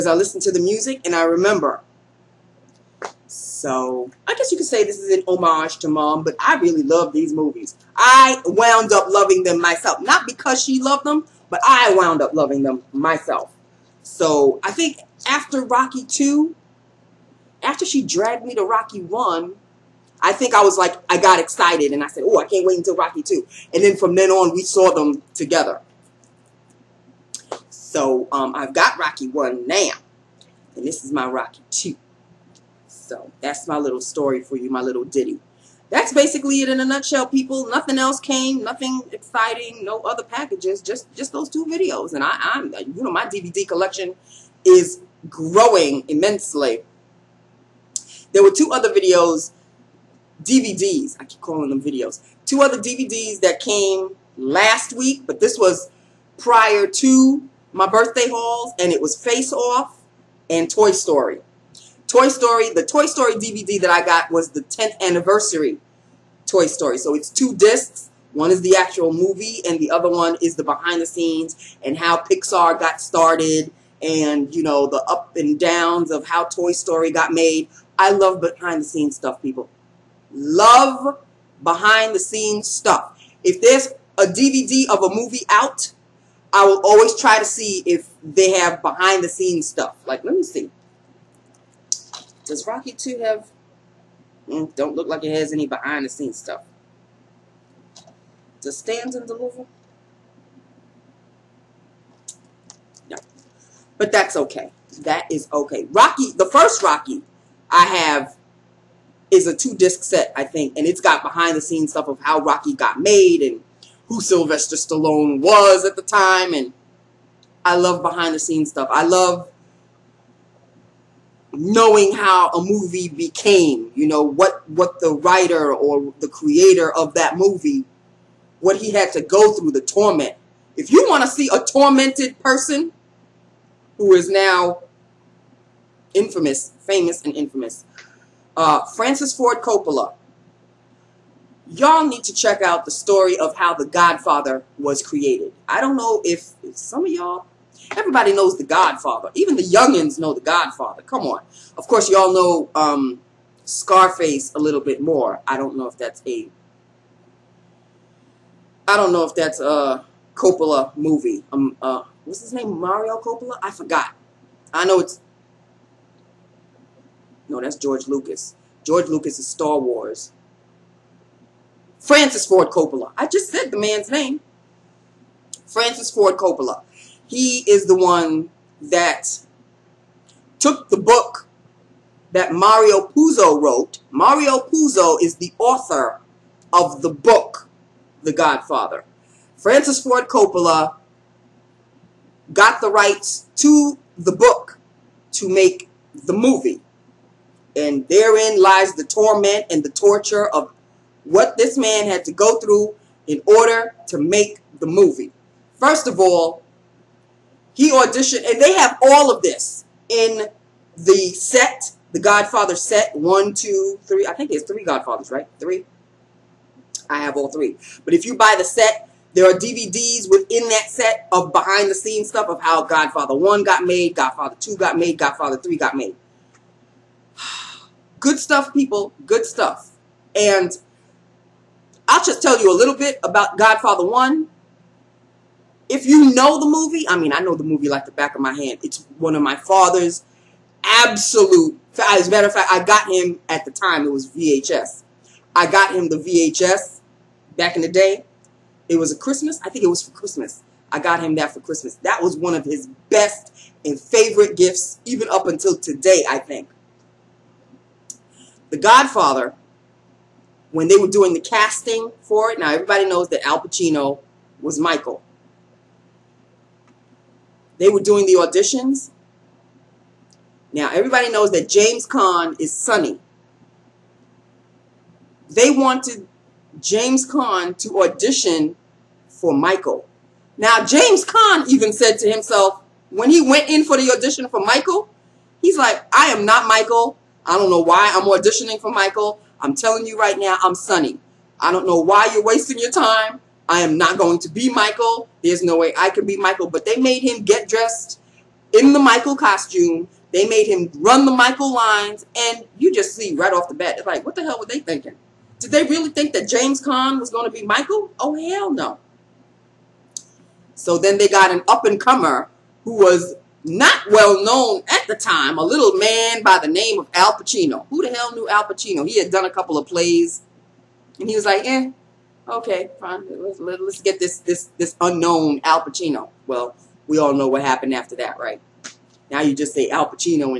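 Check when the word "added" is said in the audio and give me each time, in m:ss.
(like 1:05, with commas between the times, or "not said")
not said.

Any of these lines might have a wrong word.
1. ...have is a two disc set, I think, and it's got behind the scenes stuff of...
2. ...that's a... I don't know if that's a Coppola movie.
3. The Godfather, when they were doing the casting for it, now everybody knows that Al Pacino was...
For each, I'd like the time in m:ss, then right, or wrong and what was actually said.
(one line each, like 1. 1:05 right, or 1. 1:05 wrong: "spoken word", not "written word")
1. 1:47 right
2. 2:35 right
3. 4:18 right.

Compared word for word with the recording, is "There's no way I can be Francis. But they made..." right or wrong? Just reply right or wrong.
wrong.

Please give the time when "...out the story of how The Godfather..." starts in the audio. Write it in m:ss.
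2:22.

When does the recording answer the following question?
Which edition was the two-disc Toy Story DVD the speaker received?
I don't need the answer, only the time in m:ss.
1:04.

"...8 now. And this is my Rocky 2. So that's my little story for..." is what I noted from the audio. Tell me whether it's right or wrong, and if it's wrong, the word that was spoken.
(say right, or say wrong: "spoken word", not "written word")
wrong: "1", not "8".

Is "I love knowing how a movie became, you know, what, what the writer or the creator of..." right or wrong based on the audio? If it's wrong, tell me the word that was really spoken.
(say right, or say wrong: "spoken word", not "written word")
right.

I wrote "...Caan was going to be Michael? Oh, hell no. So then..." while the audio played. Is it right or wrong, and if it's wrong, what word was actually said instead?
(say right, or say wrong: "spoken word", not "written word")
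right.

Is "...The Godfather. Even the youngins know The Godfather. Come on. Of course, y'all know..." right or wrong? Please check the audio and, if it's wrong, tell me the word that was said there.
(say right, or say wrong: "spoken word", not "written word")
right.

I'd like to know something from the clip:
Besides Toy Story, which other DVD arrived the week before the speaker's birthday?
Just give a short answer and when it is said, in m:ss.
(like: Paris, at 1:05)
Face Off, at 0:59.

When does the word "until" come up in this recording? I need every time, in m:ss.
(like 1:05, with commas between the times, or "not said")
0:22, 4:15.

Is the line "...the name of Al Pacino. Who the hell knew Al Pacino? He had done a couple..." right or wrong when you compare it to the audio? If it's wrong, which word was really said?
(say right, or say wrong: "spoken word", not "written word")
right.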